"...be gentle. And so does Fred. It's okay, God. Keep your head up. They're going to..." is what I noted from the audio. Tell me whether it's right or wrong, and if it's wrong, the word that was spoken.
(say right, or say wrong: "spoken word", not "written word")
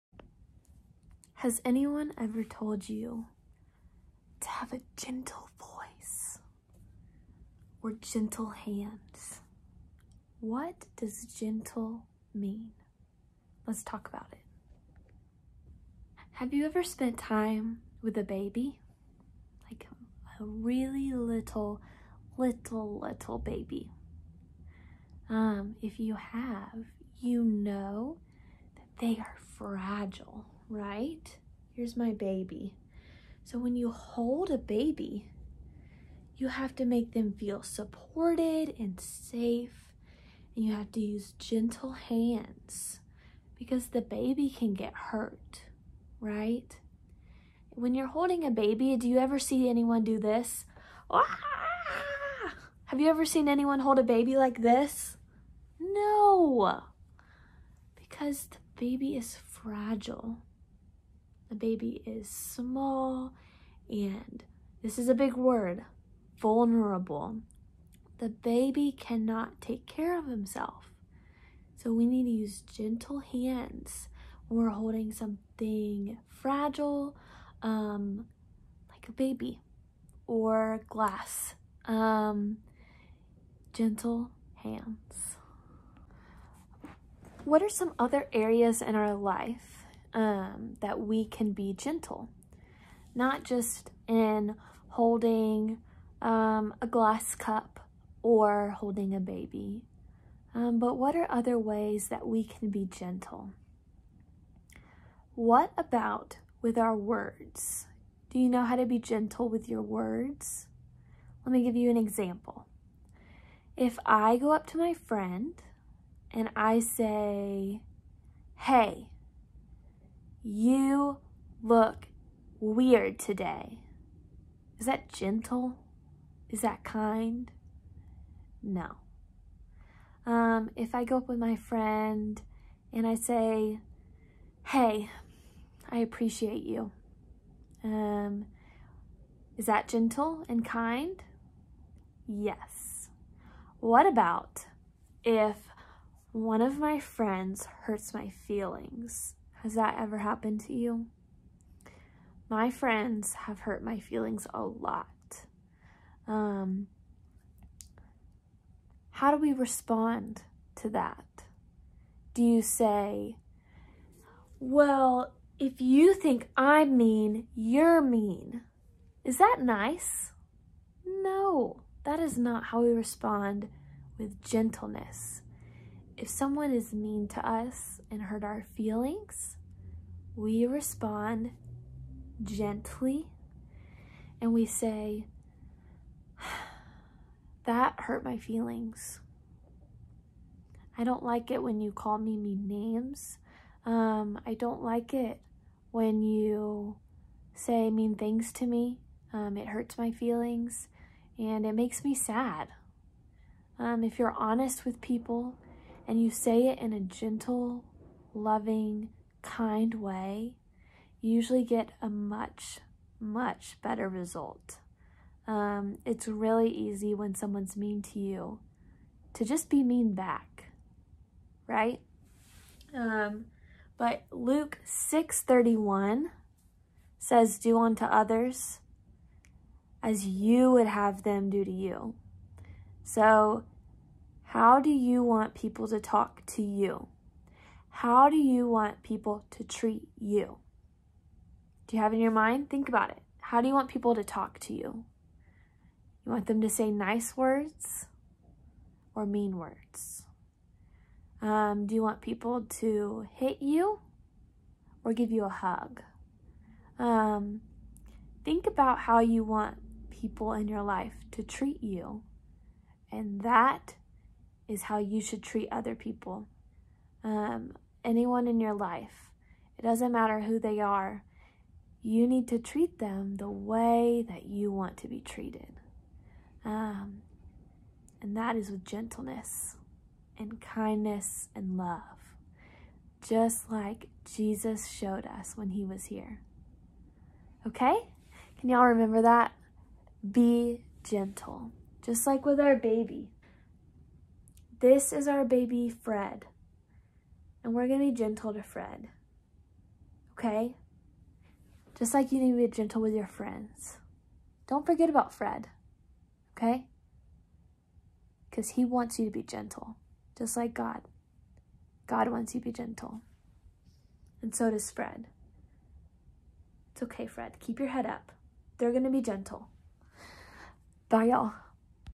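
wrong: "Fred", not "God".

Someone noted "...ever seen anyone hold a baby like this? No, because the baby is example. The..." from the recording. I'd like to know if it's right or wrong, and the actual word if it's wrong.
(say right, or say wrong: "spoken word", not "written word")
wrong: "fragile", not "example".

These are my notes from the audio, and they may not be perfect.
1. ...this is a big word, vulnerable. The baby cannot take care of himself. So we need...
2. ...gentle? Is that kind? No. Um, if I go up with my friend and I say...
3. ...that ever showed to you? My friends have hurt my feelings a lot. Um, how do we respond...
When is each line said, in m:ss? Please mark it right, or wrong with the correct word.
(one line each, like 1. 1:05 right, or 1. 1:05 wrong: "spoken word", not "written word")
1. 1:04 right
2. 2:05 right
3. 2:29 wrong: "happened", not "showed".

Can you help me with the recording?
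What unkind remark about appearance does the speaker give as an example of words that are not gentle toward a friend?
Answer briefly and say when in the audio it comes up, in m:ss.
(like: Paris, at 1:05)
You look weird today, at 2:00.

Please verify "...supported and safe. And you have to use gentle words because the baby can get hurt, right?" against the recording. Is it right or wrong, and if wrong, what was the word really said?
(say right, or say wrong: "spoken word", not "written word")
wrong: "hands", not "words".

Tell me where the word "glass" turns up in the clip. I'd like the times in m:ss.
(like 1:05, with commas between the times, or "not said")
1:20, 1:36.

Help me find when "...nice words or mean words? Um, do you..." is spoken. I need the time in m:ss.
4:06.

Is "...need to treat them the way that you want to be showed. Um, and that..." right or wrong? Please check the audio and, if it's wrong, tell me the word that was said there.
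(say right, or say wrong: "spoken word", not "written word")
wrong: "treated", not "showed".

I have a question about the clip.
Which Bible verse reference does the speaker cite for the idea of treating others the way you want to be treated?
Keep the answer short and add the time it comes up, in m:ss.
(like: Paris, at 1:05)
Luke 6:31, at 3:44.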